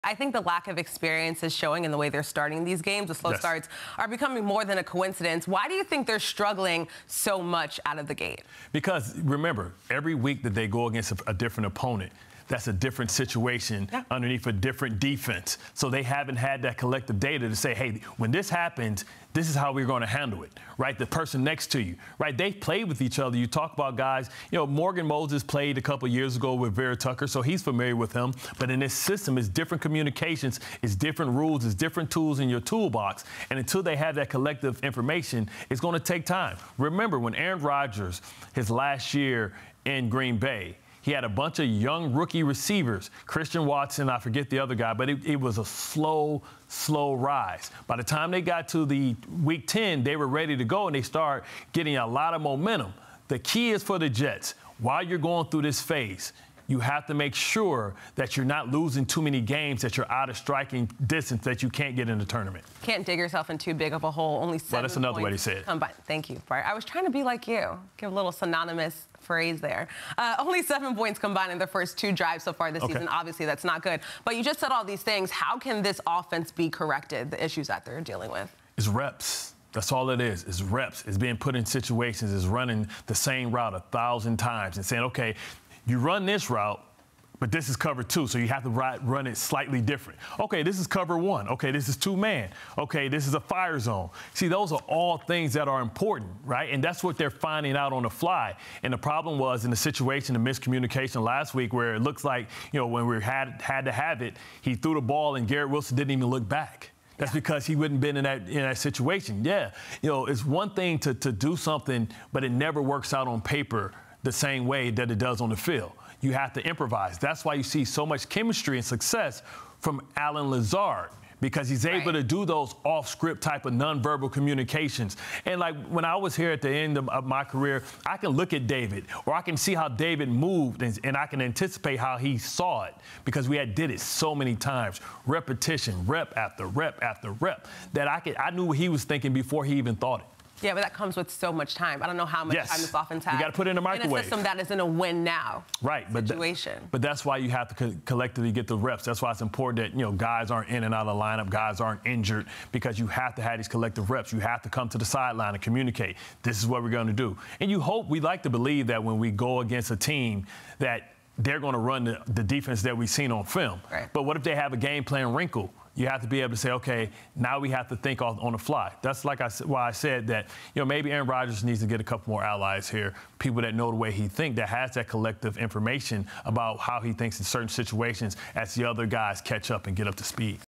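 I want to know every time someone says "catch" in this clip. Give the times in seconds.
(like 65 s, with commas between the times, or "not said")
179 s.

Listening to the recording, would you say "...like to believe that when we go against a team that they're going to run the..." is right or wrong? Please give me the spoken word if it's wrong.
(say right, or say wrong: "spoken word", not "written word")
right.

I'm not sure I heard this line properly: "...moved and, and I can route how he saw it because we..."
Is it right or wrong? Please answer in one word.
wrong.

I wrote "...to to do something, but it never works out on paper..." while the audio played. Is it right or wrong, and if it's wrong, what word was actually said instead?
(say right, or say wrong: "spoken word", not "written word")
right.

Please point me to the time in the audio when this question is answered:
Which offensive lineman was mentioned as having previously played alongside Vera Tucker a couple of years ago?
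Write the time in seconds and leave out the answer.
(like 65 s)
24 s.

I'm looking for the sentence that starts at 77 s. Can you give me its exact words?
The issues that they're dealing with.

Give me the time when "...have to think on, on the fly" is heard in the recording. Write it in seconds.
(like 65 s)
167 s.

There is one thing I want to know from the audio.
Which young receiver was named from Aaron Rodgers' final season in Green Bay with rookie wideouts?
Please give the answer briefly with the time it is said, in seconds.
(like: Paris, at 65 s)
Christian Watson, at 43 s.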